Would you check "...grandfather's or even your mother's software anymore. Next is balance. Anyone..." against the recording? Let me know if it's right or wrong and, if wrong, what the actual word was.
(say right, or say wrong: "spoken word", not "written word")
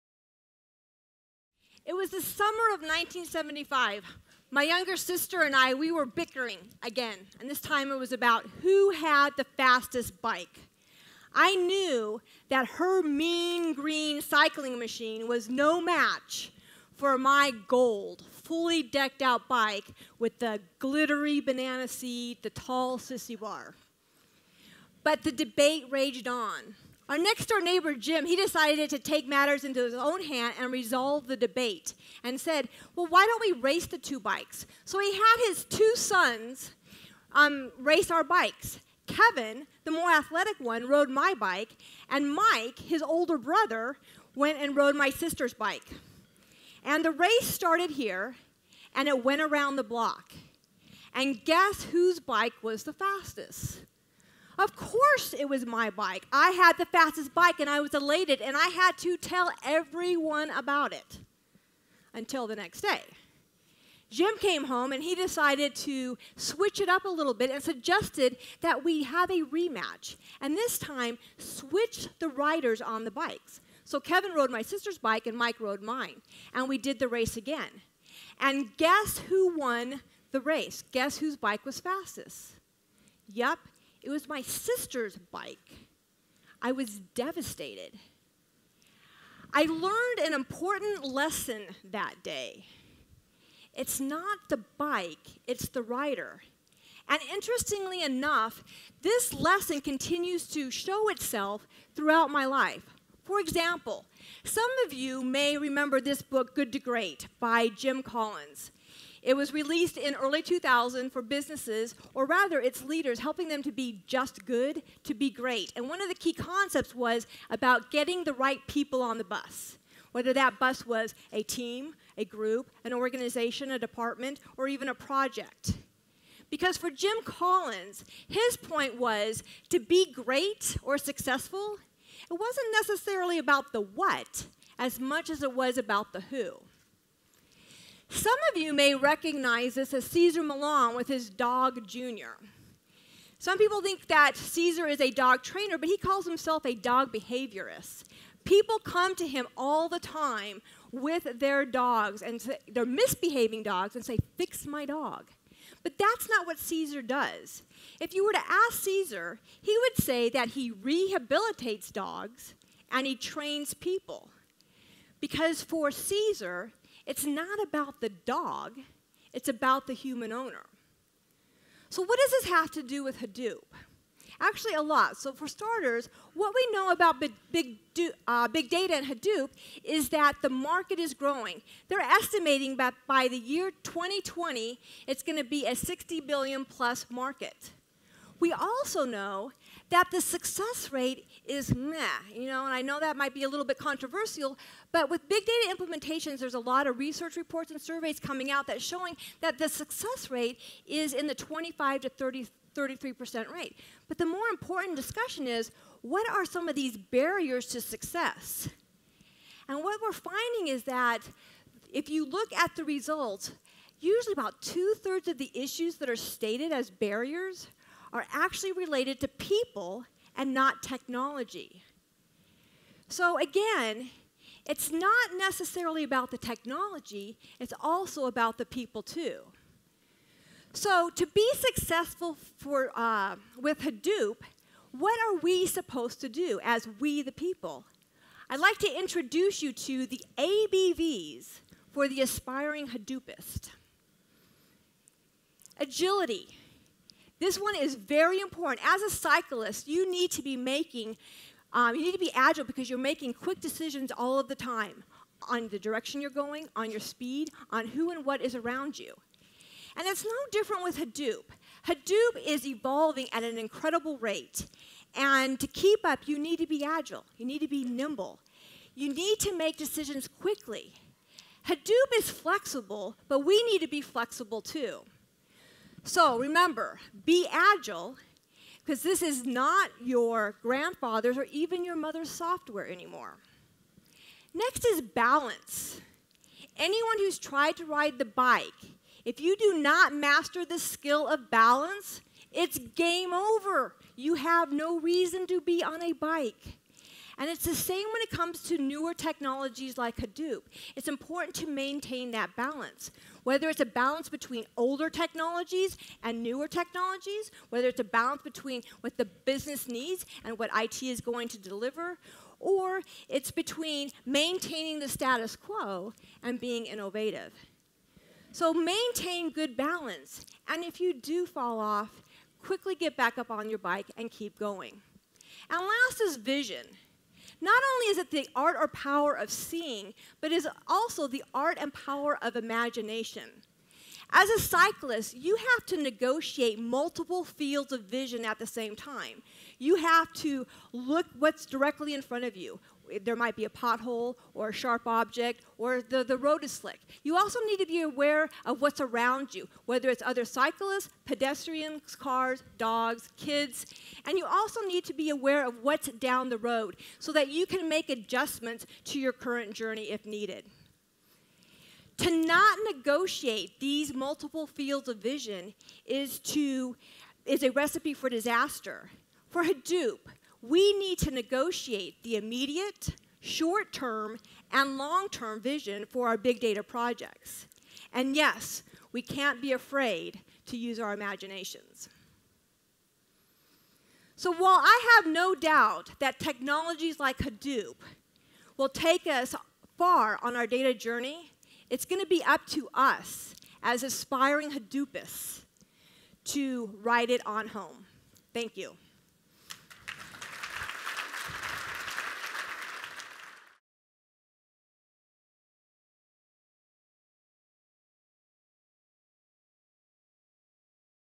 right.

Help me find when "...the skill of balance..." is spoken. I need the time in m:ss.
4:50.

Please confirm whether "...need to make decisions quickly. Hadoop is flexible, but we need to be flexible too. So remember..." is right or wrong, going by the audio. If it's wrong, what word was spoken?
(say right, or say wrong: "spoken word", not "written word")
right.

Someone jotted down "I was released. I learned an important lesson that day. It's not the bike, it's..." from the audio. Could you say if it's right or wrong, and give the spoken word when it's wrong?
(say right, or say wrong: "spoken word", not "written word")
wrong: "devastated", not "released".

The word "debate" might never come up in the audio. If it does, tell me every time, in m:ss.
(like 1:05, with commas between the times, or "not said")
0:25, 0:31.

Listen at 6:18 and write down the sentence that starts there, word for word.
And yes, we can't be afraid to use our imaginations.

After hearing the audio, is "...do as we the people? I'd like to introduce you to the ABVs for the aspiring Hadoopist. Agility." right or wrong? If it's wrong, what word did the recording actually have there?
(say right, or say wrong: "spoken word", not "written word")
right.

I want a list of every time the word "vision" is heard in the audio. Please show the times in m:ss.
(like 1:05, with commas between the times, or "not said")
5:26, 5:38, 6:05, 6:15.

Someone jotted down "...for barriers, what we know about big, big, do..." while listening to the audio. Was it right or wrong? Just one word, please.
wrong.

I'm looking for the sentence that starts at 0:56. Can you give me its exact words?
I had the fastest bike and I was elated, and I had to tell everyone about it until the next day.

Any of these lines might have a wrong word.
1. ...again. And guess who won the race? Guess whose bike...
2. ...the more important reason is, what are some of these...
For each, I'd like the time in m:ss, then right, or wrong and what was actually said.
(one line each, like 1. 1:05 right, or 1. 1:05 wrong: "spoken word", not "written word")
1. 1:17 right
2. 3:24 wrong: "discussion", not "reason".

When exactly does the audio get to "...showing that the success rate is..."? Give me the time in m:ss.
3:18.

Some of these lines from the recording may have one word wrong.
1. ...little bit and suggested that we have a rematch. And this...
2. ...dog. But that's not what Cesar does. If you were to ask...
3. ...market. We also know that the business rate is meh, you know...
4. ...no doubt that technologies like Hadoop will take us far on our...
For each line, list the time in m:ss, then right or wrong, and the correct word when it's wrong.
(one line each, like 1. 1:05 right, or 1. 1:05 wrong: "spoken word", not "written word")
1. 1:07 right
2. 2:34 right
3. 3:07 wrong: "success", not "business"
4. 6:25 right.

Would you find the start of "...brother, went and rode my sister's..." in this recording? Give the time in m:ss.
0:43.